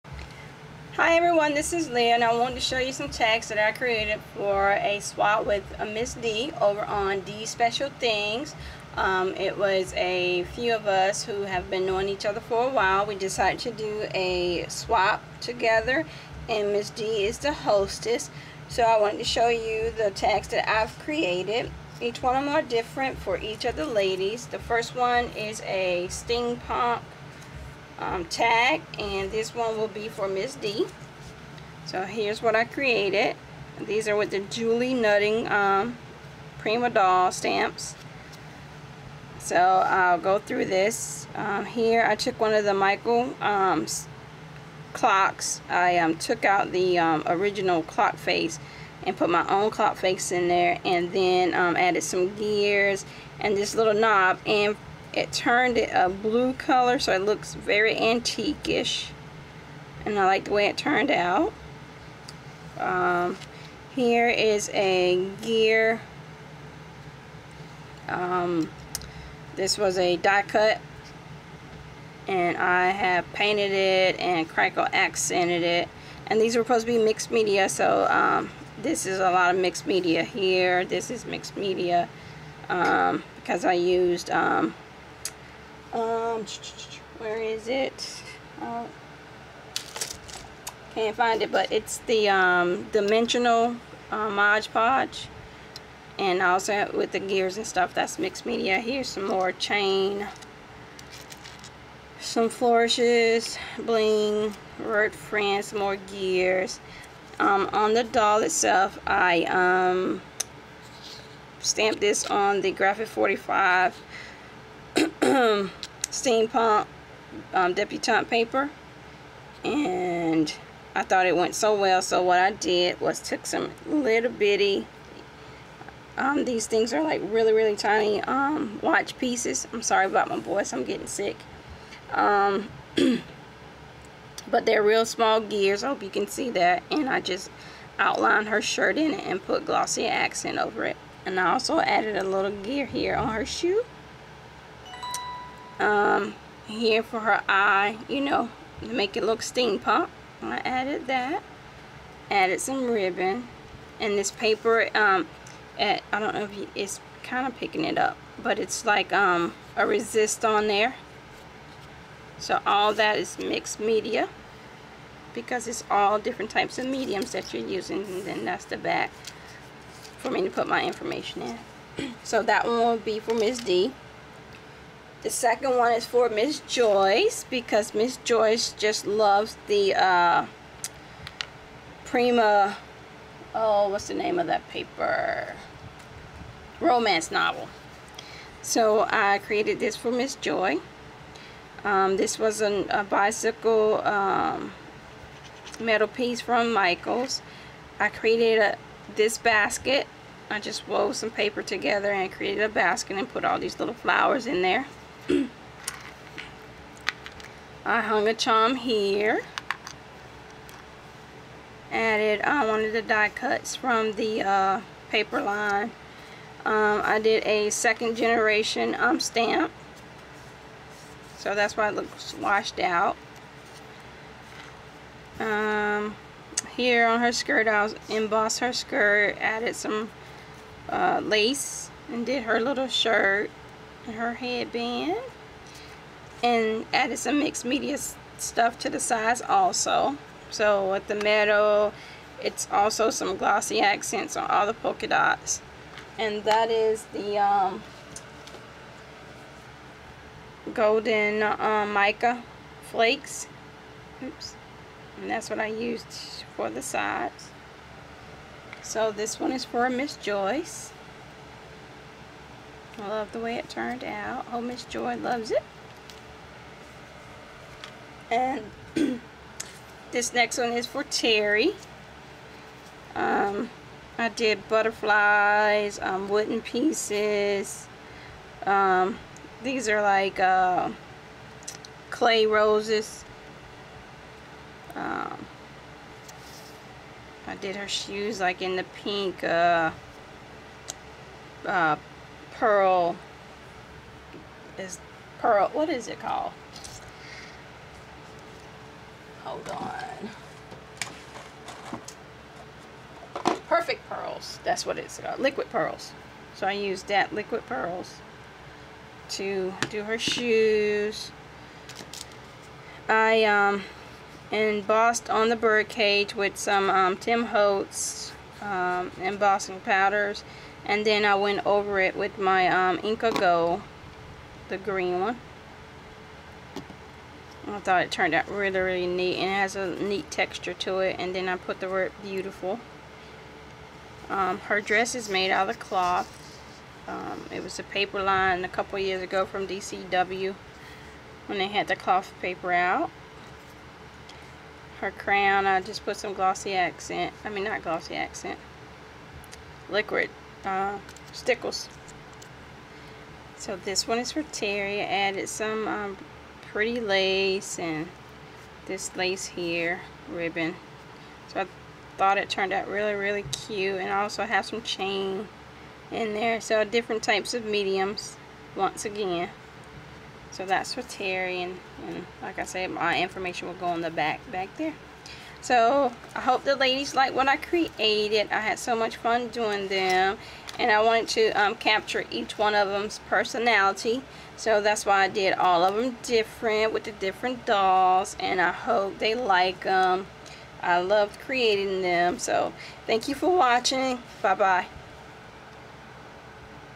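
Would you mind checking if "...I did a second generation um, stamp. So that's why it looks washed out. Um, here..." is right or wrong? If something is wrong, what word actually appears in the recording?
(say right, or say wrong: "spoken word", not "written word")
right.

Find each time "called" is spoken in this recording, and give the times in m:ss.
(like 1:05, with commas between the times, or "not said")
4:56, 5:05.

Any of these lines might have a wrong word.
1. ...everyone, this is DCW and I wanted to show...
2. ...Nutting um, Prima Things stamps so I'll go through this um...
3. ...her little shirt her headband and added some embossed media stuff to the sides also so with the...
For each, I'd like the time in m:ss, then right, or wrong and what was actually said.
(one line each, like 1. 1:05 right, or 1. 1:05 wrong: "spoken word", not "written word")
1. 0:01 wrong: "Leah", not "DCW"
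2. 0:34 wrong: "Doll", not "Things"
3. 3:52 wrong: "mixed", not "embossed".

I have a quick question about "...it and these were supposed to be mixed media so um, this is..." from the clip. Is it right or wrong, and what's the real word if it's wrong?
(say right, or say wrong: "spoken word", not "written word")
right.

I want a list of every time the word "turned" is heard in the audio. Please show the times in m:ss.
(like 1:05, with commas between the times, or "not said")
0:55, 1:00, 4:23, 5:28, 6:02.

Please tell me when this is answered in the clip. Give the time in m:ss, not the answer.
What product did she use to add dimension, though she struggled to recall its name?
1:34.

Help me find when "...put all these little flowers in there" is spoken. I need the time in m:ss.
3:23.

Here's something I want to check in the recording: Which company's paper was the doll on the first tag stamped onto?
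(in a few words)
Graphic 45.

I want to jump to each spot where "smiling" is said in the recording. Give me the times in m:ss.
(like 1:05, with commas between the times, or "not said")
not said.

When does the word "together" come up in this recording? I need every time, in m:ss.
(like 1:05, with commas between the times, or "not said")
0:15, 3:21.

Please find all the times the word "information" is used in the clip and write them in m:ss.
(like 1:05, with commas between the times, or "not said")
2:50, 6:13.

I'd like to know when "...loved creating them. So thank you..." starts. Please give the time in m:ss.
6:30.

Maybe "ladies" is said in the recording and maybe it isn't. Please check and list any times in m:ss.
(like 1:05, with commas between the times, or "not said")
0:23, 6:16.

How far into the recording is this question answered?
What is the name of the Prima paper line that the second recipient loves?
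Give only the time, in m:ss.
3:06.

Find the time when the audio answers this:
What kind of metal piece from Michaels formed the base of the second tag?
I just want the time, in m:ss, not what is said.
3:13.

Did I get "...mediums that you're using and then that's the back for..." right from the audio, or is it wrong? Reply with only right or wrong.
right.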